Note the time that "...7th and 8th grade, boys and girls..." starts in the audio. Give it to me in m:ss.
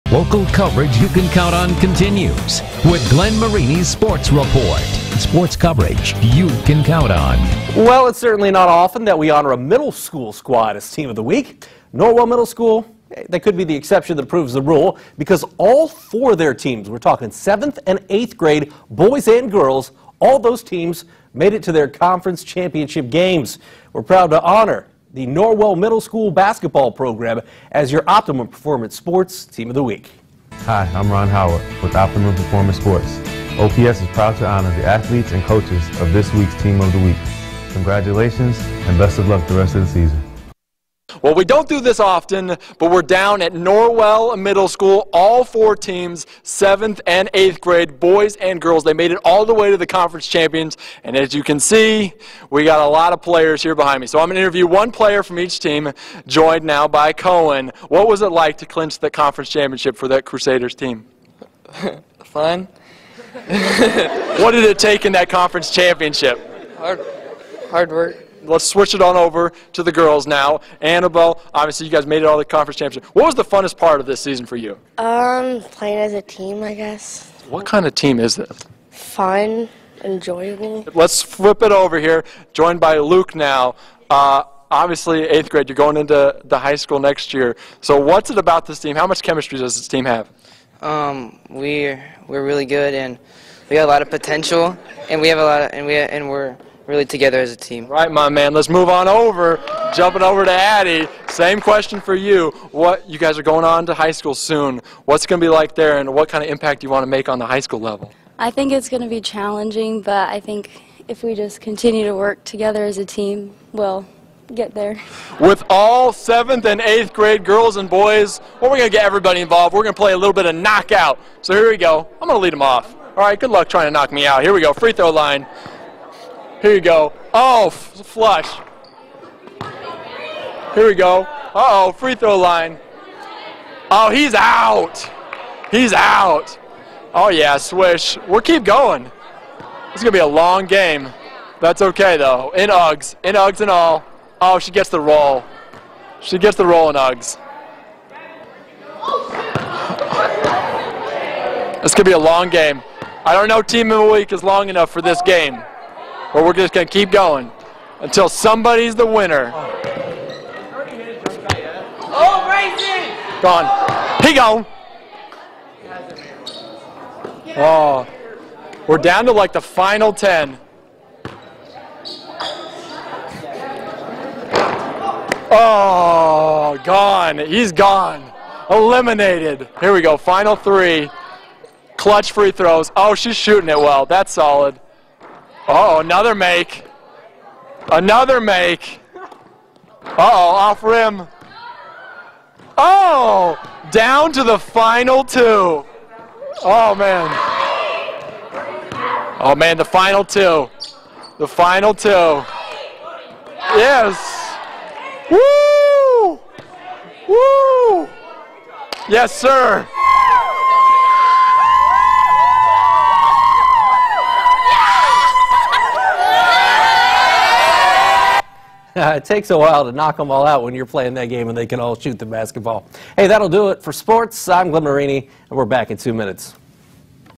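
0:17.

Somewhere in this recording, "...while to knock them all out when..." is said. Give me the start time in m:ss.
3:39.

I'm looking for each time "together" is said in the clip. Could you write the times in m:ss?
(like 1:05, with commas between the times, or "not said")
1:37, 1:52.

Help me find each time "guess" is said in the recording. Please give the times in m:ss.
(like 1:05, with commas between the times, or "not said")
1:16.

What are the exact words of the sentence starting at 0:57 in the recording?
What was it like to clinch the conference championship for that Crusaders team?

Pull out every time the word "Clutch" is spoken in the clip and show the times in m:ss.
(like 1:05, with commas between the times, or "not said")
3:01.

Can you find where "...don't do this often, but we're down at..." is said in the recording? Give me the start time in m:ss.
0:41.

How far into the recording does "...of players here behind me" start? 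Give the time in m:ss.
0:53.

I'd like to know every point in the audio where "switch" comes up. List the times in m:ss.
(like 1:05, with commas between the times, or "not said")
1:08.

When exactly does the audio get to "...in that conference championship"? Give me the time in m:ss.
1:05.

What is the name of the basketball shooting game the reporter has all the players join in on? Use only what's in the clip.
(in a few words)
Knockout.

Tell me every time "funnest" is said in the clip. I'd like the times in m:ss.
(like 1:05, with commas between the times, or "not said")
1:13.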